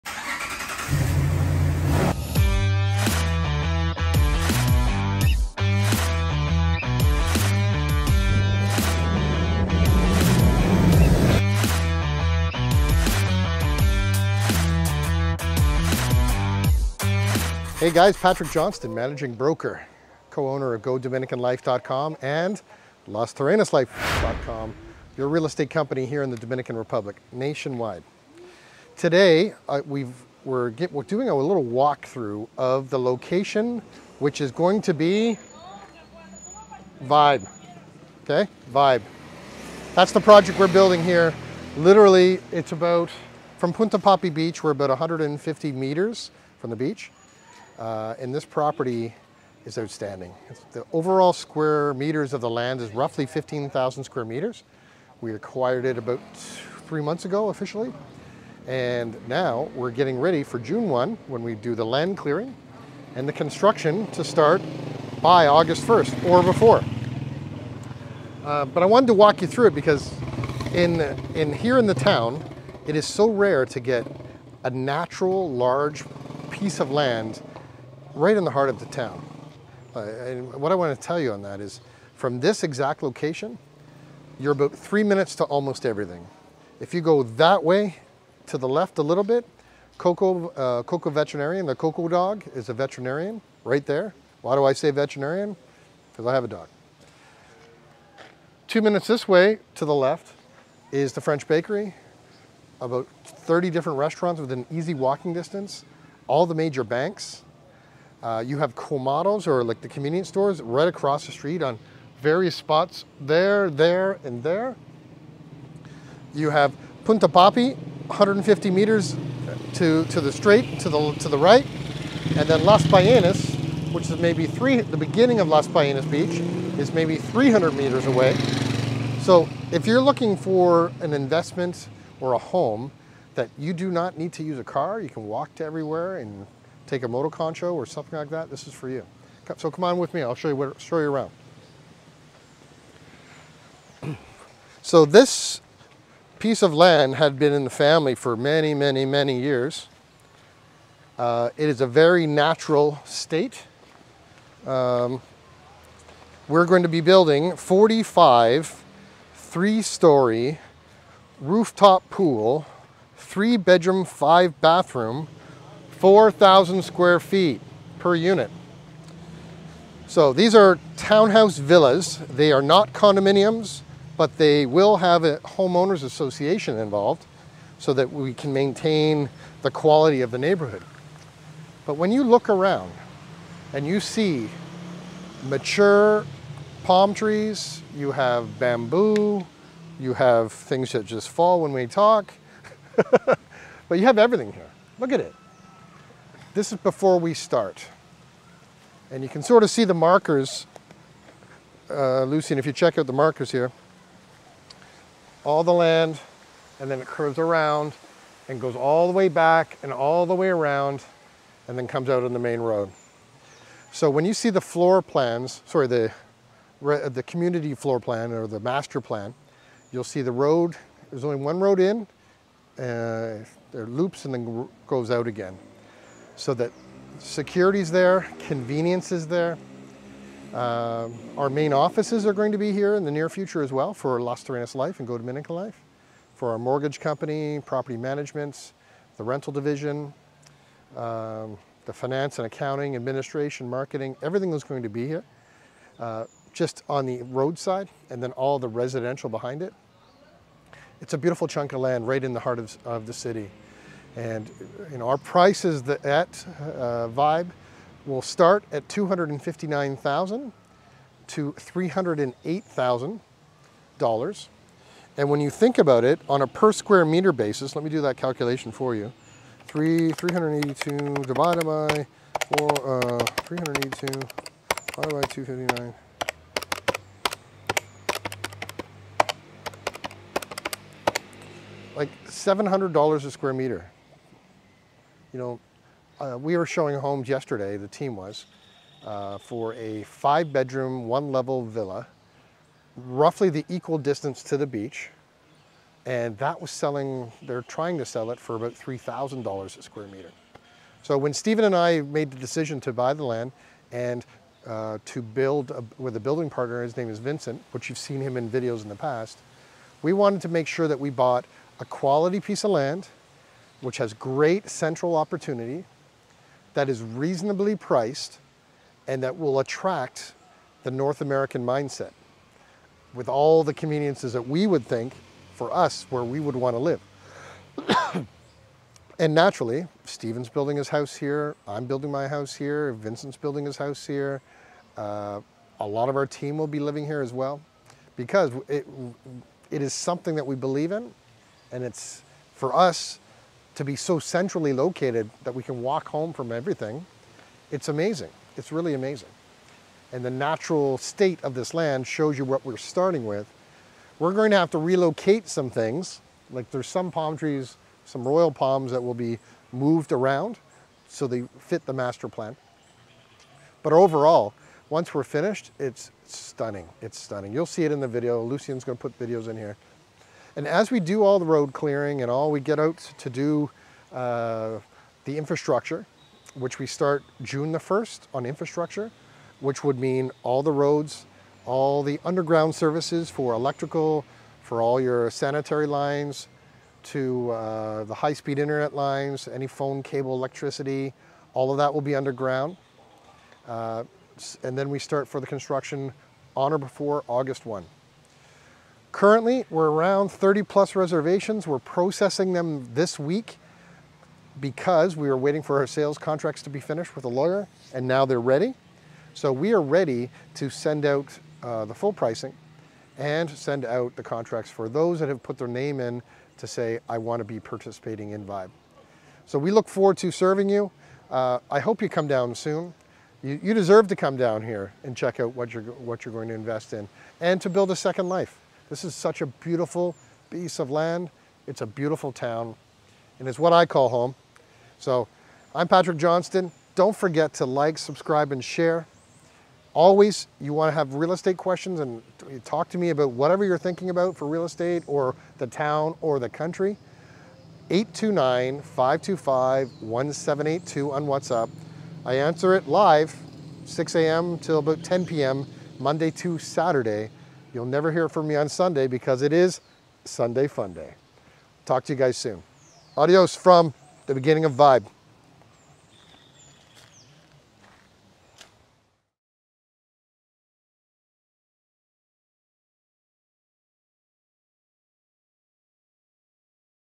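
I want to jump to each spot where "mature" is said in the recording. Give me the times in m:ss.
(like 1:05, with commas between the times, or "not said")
3:05.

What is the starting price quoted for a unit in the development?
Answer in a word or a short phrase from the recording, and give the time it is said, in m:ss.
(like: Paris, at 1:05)
$259,000, at 4:18.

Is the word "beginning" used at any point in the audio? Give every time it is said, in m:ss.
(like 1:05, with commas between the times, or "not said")
2:04, 7:44.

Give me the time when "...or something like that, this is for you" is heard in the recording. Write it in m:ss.
2:17.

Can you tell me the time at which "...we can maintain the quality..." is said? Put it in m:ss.
2:58.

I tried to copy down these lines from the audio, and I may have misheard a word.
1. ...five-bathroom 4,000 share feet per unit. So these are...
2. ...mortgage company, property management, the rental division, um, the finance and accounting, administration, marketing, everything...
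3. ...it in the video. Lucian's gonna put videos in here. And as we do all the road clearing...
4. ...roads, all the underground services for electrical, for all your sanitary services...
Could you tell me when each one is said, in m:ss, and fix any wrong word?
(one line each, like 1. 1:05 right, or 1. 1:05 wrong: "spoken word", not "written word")
1. 2:44 wrong: "square", not "share"
2. 3:56 right
3. 6:07 right
4. 6:20 wrong: "lines", not "services".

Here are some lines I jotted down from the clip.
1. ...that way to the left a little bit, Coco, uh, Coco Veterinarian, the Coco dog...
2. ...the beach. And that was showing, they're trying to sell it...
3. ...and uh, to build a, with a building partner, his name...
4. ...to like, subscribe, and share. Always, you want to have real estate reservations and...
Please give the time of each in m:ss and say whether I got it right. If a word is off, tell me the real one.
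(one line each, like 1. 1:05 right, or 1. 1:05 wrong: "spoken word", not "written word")
1. 1:27 right
2. 4:54 wrong: "selling", not "showing"
3. 5:03 right
4. 7:17 wrong: "questions", not "reservations".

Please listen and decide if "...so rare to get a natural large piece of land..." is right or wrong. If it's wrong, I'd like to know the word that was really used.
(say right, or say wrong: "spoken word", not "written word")
right.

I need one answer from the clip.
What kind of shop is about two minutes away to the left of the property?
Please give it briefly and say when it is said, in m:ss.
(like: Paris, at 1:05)
French bakery, at 1:41.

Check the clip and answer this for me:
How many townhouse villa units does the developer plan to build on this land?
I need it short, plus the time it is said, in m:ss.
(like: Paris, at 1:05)
45, at 2:37.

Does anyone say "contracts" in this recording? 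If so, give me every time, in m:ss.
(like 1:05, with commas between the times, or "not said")
6:46, 6:54.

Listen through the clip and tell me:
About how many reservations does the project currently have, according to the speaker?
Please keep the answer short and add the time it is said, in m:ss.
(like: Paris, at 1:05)
30 plus, at 6:40.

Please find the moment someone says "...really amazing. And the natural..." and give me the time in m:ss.
5:48.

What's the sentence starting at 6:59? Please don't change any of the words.
So we look forward to serving you.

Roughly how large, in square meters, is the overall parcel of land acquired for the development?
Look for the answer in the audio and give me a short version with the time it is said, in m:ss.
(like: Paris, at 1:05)
15,000 square meters, at 0:53.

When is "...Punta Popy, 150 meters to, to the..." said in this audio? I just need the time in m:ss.
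1:57.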